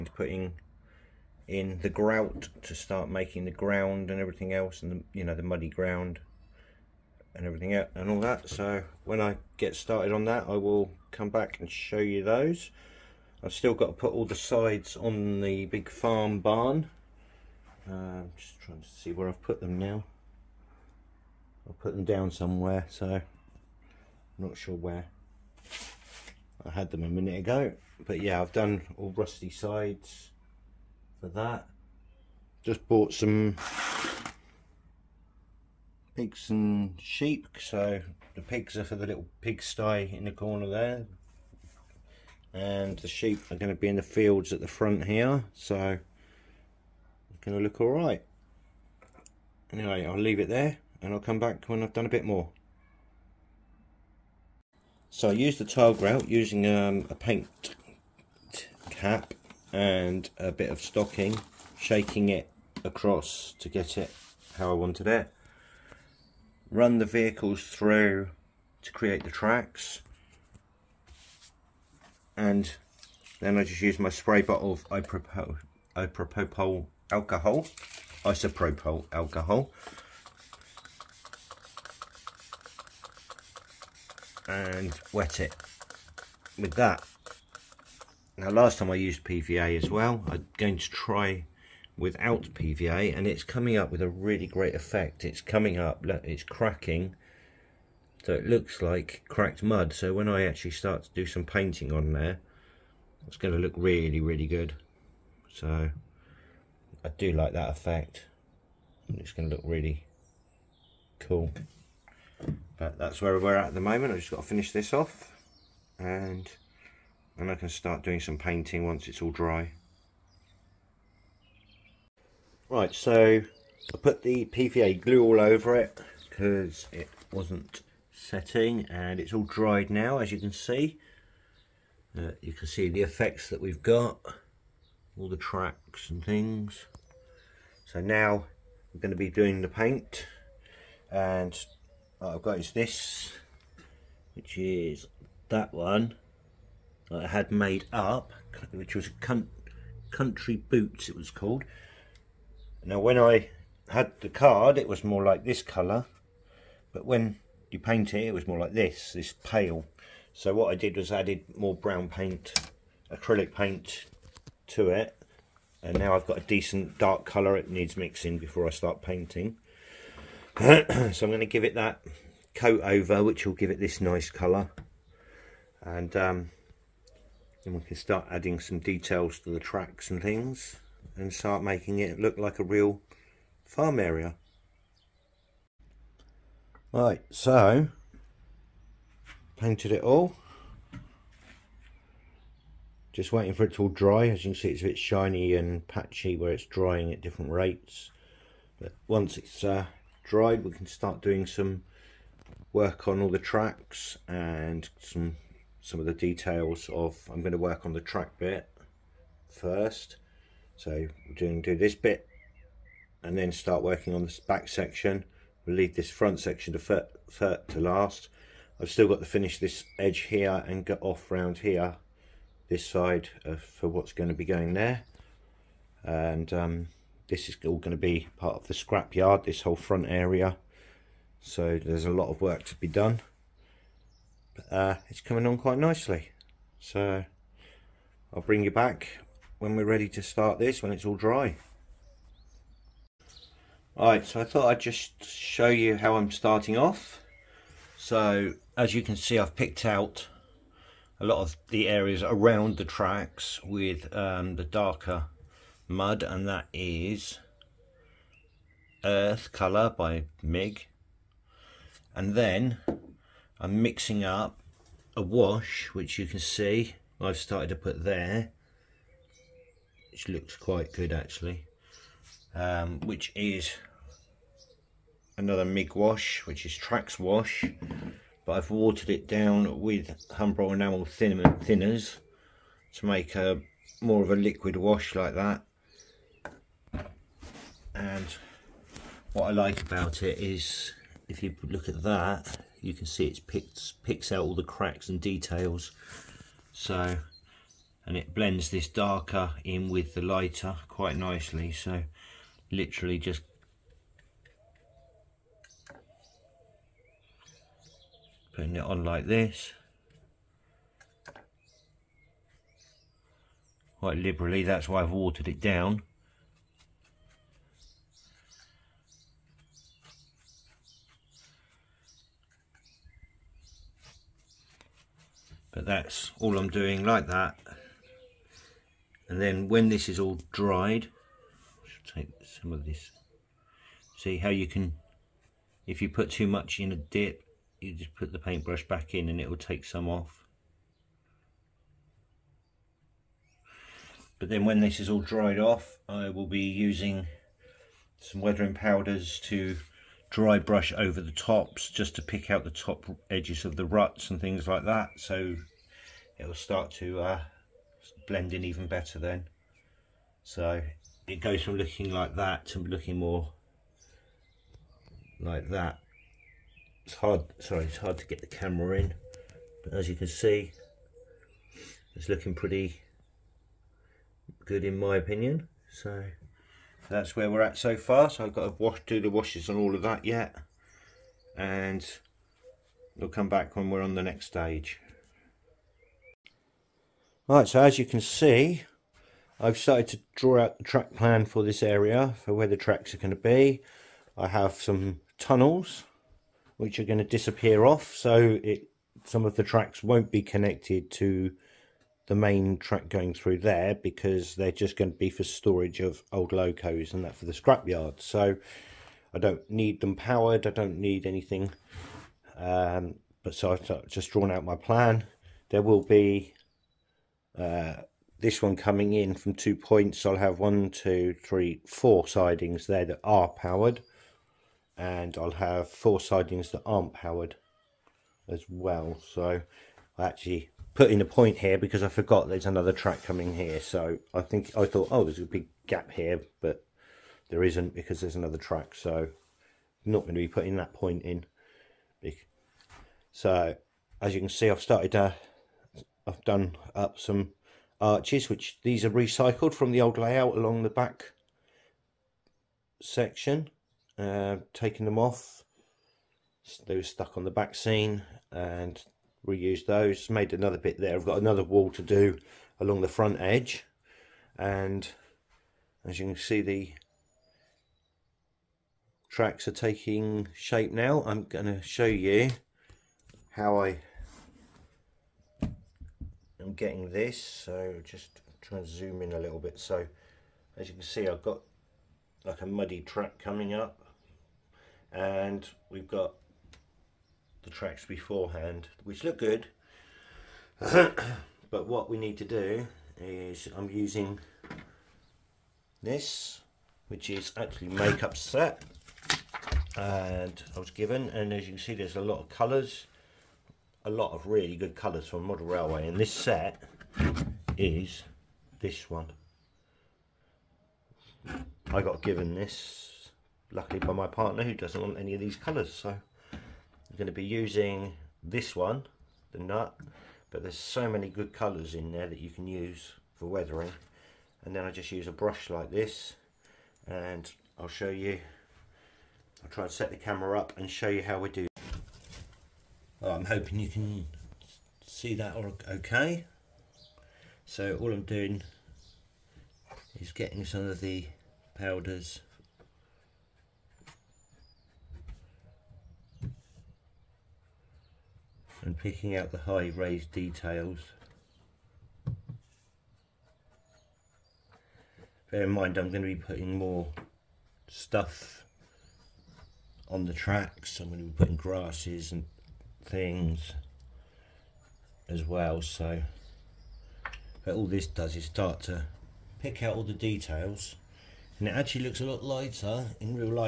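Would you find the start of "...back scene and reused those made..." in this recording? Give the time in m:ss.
7:37.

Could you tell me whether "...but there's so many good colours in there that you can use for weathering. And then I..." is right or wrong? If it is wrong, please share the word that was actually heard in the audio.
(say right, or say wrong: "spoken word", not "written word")
right.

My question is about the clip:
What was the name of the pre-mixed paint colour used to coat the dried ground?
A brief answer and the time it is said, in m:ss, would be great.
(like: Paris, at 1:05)
Country Boots, at 2:30.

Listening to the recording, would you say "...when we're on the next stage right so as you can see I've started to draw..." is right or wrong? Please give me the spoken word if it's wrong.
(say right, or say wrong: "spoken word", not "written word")
right.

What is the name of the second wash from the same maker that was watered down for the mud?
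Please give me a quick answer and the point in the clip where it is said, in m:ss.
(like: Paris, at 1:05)
Tracks wash, at 4:36.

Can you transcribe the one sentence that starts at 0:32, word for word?
Just bought some pigs and sheep.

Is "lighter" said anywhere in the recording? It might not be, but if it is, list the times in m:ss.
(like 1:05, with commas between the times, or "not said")
5:00, 9:32.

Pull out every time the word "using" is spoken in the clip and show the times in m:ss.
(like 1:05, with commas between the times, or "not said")
0:56, 5:46, 8:13, 8:37.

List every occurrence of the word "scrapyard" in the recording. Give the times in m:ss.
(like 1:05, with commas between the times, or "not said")
3:48, 6:47.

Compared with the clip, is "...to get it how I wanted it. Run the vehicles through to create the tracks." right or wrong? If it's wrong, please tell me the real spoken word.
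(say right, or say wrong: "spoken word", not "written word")
right.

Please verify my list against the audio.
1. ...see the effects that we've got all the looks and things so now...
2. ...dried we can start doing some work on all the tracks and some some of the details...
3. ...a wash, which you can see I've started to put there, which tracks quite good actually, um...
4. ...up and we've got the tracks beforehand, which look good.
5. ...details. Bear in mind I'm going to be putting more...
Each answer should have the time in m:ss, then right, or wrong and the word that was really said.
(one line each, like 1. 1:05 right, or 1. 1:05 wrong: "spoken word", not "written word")
1. 2:12 wrong: "tracks", not "looks"
2. 3:20 right
3. 4:25 wrong: "looks", not "tracks"
4. 8:03 right
5. 9:10 right.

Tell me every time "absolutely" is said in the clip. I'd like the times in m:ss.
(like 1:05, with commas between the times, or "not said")
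not said.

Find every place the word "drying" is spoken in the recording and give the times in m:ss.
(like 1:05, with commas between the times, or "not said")
3:16.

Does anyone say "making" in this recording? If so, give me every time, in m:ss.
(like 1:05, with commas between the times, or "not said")
0:03, 3:01.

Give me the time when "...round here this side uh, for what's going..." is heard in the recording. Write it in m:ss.
3:41.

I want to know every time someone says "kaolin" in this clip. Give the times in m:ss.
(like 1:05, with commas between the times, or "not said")
not said.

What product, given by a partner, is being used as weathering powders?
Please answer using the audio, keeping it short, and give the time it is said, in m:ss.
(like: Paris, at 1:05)
Makeup set, at 8:17.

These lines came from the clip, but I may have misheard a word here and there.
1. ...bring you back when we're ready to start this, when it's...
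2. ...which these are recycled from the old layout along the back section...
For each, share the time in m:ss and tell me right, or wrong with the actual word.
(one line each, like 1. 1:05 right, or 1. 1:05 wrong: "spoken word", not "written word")
1. 3:58 right
2. 7:28 right.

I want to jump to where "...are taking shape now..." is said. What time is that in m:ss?
7:49.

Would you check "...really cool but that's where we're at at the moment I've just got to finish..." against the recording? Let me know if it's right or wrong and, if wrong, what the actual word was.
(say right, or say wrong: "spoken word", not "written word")
right.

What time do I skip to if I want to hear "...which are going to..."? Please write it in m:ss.
6:36.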